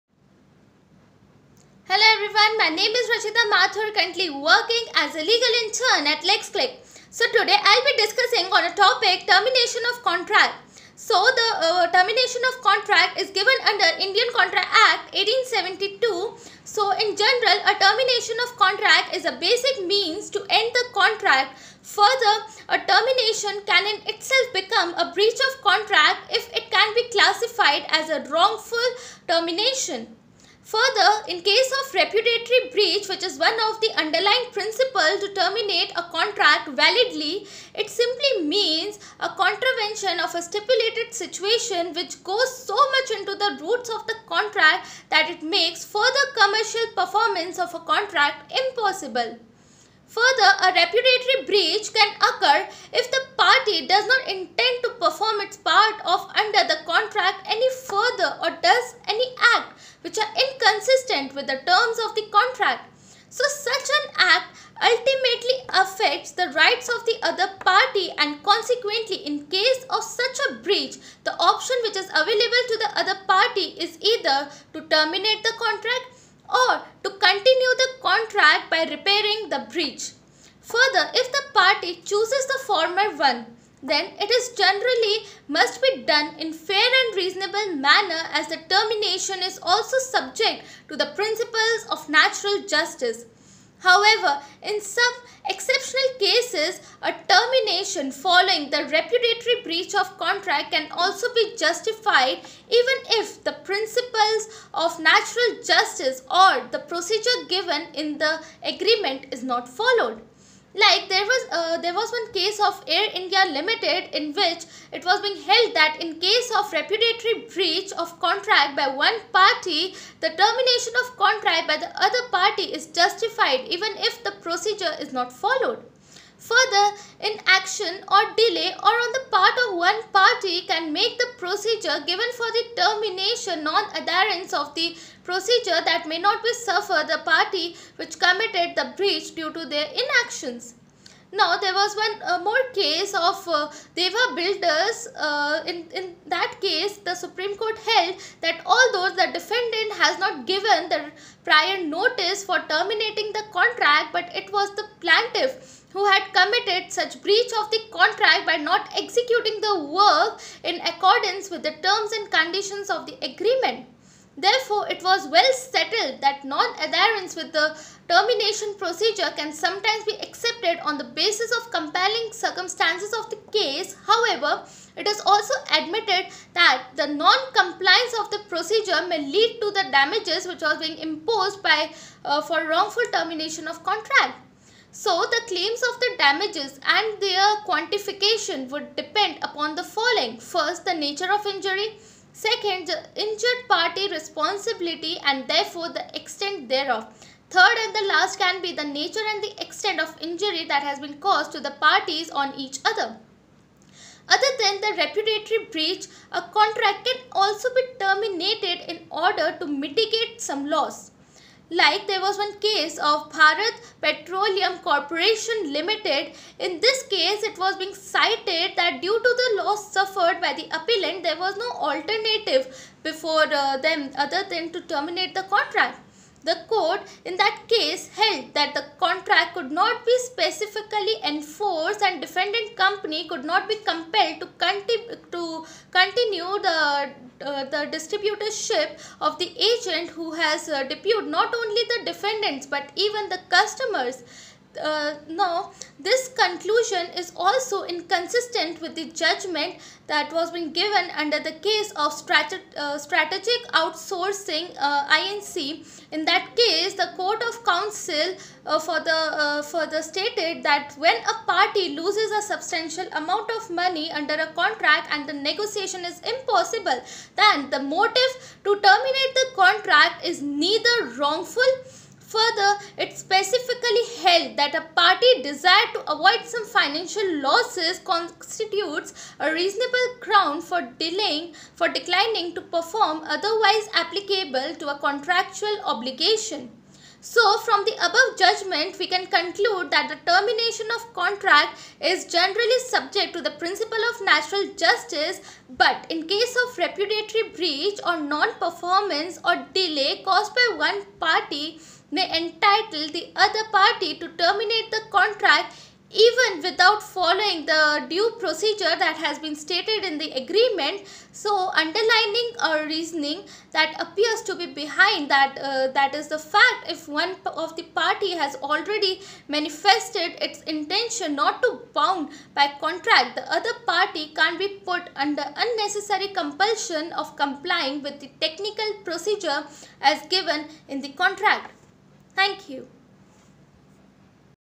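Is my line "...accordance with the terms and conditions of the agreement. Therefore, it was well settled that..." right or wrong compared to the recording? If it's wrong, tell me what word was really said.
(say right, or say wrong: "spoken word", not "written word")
right.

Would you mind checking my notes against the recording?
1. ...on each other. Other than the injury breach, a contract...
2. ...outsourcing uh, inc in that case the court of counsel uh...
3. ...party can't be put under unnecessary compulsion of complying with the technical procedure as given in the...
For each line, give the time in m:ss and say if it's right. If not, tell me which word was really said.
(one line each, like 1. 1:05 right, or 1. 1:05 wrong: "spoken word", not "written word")
1. 3:22 wrong: "repudiatory", not "injury"
2. 4:13 right
3. 5:23 right.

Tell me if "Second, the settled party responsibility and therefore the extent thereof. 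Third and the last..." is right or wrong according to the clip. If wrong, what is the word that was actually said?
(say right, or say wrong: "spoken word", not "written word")
wrong: "injured", not "settled".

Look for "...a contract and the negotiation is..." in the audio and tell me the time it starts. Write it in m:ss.
4:24.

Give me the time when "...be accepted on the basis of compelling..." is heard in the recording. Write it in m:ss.
2:50.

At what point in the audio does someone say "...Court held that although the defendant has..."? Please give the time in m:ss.
2:27.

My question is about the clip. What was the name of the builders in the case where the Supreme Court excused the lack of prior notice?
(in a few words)
Deva builders.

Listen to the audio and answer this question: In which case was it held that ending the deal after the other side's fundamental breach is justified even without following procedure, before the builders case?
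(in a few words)
Air India Limited.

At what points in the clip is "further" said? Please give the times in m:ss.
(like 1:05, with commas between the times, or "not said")
0:21, 0:30, 0:45, 0:50, 0:57, 1:20, 2:06, 4:32.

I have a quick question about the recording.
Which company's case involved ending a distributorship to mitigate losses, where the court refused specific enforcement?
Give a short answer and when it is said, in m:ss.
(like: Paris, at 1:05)
Bharat Petroleum Corporation Limited, at 3:33.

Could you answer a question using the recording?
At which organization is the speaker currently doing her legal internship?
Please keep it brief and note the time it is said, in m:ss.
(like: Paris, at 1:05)
LexCliq, at 0:06.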